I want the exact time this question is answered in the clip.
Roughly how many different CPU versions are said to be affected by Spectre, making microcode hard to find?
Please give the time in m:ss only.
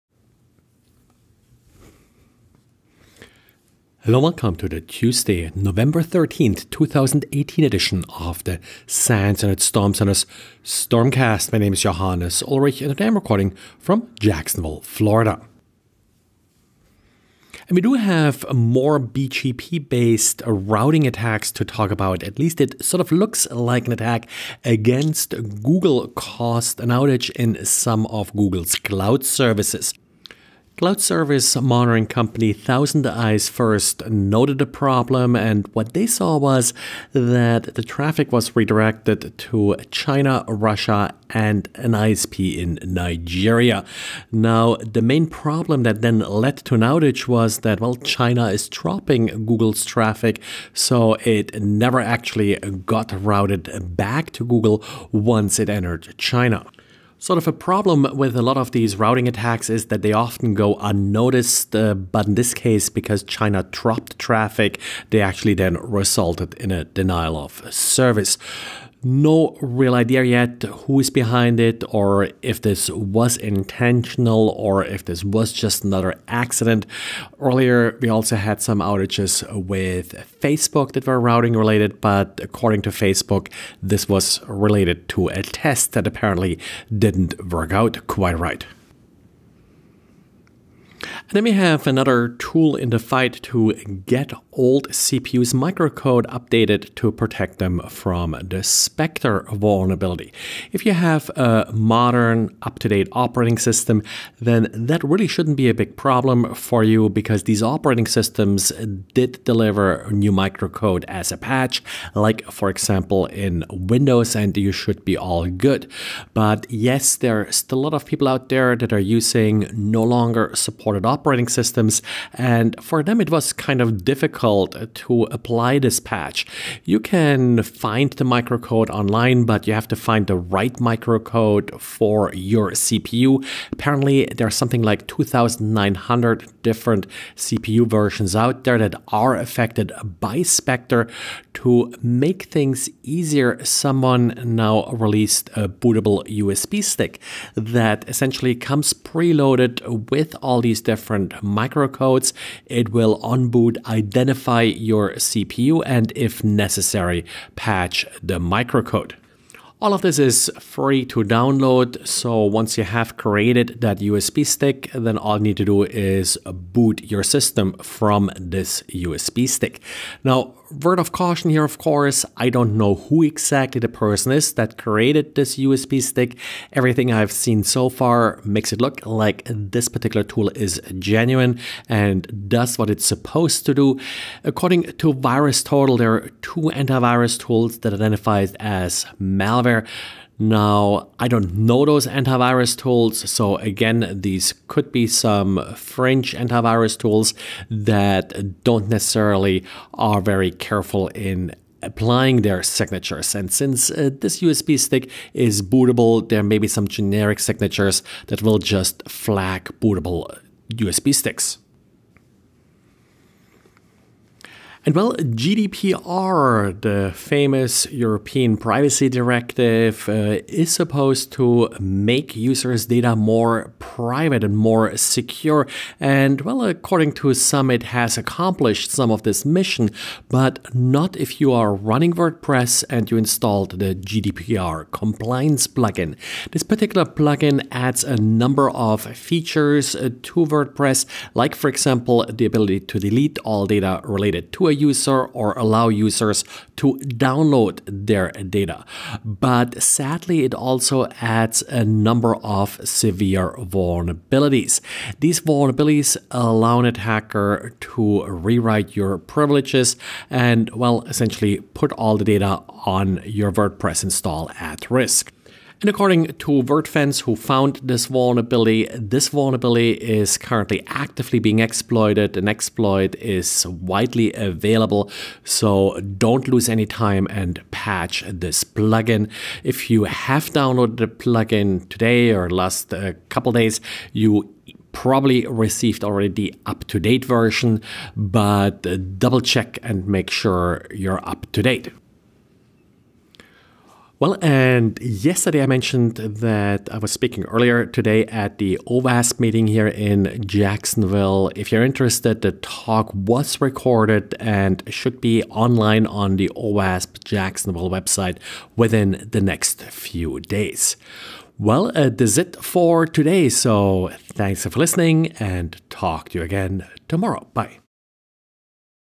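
2:15.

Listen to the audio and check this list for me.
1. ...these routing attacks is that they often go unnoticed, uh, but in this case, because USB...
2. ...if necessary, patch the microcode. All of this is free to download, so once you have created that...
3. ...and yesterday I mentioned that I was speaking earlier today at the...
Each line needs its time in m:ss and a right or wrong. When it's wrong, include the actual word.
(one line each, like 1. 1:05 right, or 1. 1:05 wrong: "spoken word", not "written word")
1. 0:58 wrong: "China", not "USB"
2. 2:36 right
3. 4:54 right.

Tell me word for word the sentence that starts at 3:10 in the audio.
Now, I don't know those antivirus tools.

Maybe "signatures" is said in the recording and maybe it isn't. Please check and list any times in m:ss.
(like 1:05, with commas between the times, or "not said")
3:22, 3:27.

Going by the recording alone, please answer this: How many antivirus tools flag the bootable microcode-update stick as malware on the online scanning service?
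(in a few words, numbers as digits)
2.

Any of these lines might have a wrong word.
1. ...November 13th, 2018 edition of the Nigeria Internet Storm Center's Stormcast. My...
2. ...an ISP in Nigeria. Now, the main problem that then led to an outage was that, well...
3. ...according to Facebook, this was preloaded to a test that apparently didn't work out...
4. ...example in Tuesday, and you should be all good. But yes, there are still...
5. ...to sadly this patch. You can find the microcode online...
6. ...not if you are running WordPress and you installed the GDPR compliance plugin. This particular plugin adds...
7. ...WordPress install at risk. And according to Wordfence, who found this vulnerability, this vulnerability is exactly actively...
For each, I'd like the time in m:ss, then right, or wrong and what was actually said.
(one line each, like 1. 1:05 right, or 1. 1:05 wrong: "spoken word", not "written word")
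1. 0:05 wrong: "SANS", not "Nigeria"
2. 0:41 right
3. 1:22 wrong: "related", not "preloaded"
4. 1:52 wrong: "Windows", not "Tuesday"
5. 2:04 wrong: "apply", not "sadly"
6. 3:50 right
7. 4:23 wrong: "currently", not "exactly".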